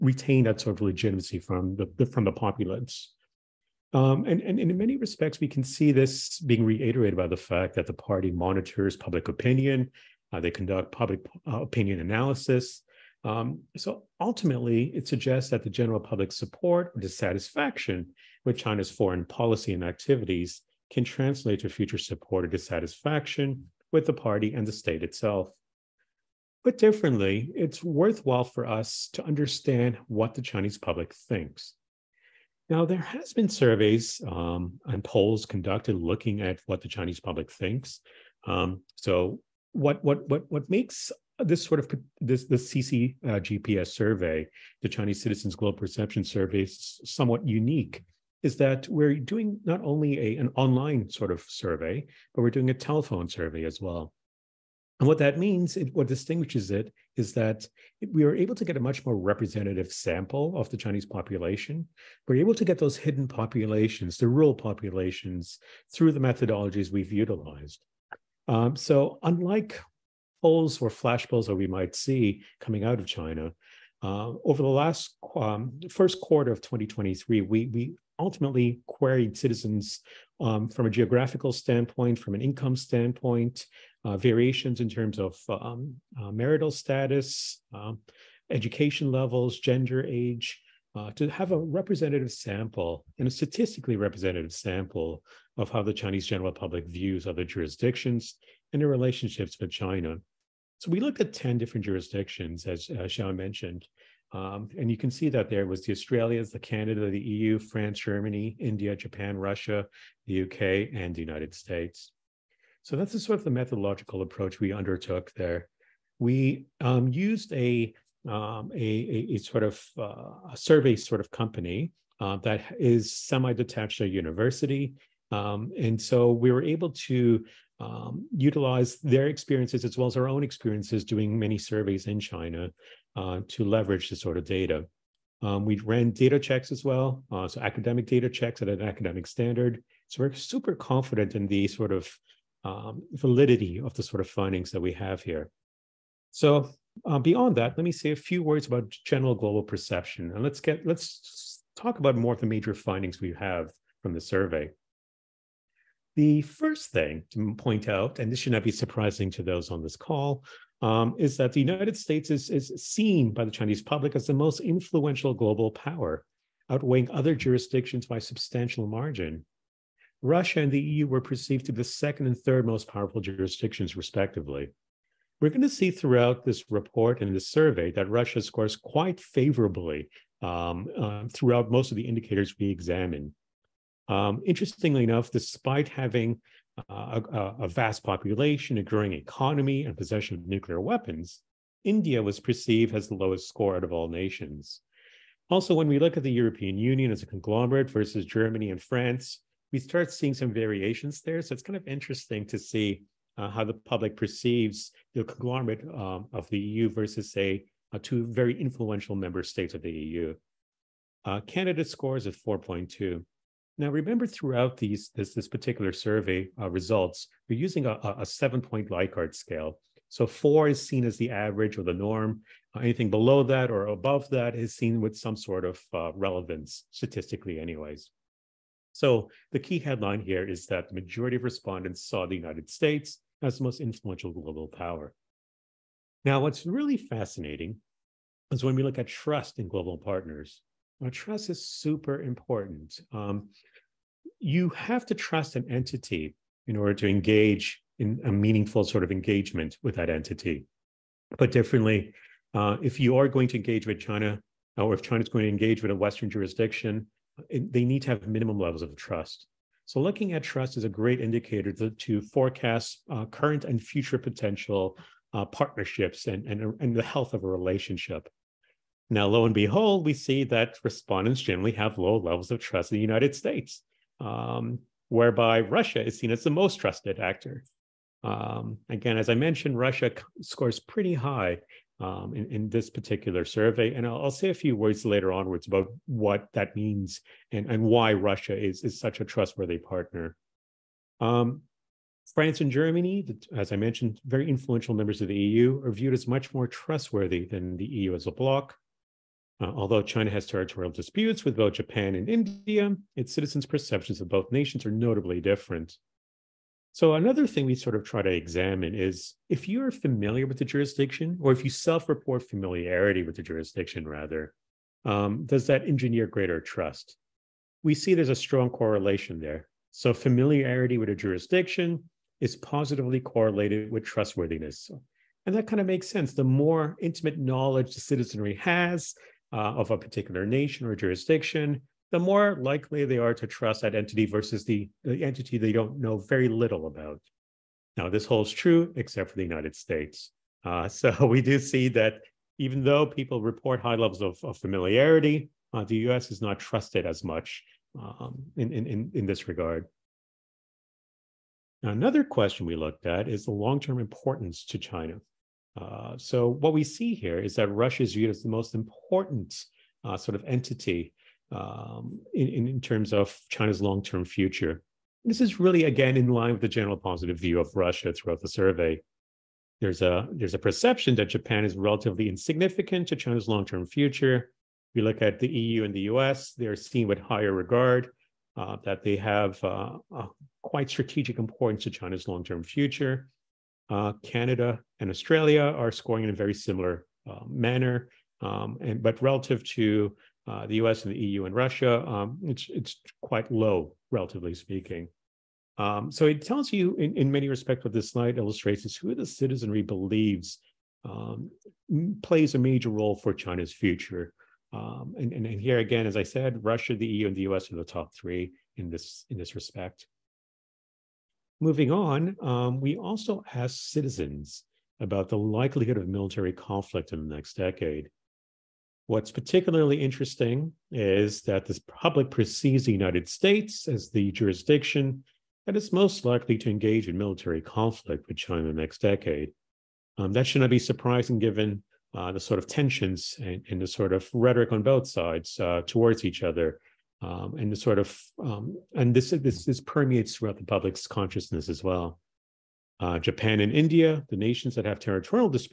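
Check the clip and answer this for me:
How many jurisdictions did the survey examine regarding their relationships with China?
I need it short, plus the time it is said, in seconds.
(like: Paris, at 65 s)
10, at 101 s.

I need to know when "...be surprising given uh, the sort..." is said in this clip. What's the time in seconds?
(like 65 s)
430 s.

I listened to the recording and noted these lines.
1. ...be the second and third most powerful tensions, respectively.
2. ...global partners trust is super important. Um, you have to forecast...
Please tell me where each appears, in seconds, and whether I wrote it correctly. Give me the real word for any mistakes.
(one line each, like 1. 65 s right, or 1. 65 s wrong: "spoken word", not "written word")
1. 171 s wrong: "jurisdictions", not "tensions"
2. 239 s wrong: "trust", not "forecast".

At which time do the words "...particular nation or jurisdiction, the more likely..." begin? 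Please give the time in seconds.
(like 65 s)
329 s.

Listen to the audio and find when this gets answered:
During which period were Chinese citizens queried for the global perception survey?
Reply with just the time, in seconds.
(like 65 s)
75 s.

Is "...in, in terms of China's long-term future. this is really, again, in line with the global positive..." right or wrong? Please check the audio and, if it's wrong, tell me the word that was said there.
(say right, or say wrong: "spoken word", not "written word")
wrong: "general", not "global".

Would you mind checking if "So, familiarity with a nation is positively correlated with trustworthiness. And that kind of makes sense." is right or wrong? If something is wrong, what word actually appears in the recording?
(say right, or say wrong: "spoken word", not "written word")
wrong: "jurisdiction", not "nation".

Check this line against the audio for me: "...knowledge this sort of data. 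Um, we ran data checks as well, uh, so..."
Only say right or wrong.
wrong.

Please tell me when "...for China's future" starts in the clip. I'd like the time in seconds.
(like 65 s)
403 s.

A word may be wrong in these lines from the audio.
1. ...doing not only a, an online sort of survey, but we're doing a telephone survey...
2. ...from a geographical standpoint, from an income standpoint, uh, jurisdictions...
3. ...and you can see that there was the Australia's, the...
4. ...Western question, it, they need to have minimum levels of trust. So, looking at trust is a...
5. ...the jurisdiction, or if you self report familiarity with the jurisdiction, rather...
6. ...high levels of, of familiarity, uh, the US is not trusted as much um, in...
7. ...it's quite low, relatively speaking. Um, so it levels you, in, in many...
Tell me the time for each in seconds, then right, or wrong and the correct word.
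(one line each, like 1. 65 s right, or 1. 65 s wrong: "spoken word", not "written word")
1. 49 s right
2. 80 s wrong: "variations", not "jurisdictions"
3. 104 s right
4. 255 s wrong: "jurisdiction", not "question"
5. 310 s right
6. 343 s right
7. 392 s wrong: "tells", not "levels".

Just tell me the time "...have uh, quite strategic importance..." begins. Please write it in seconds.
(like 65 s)
379 s.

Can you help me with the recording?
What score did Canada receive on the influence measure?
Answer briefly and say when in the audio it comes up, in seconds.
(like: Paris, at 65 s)
4.2, at 212 s.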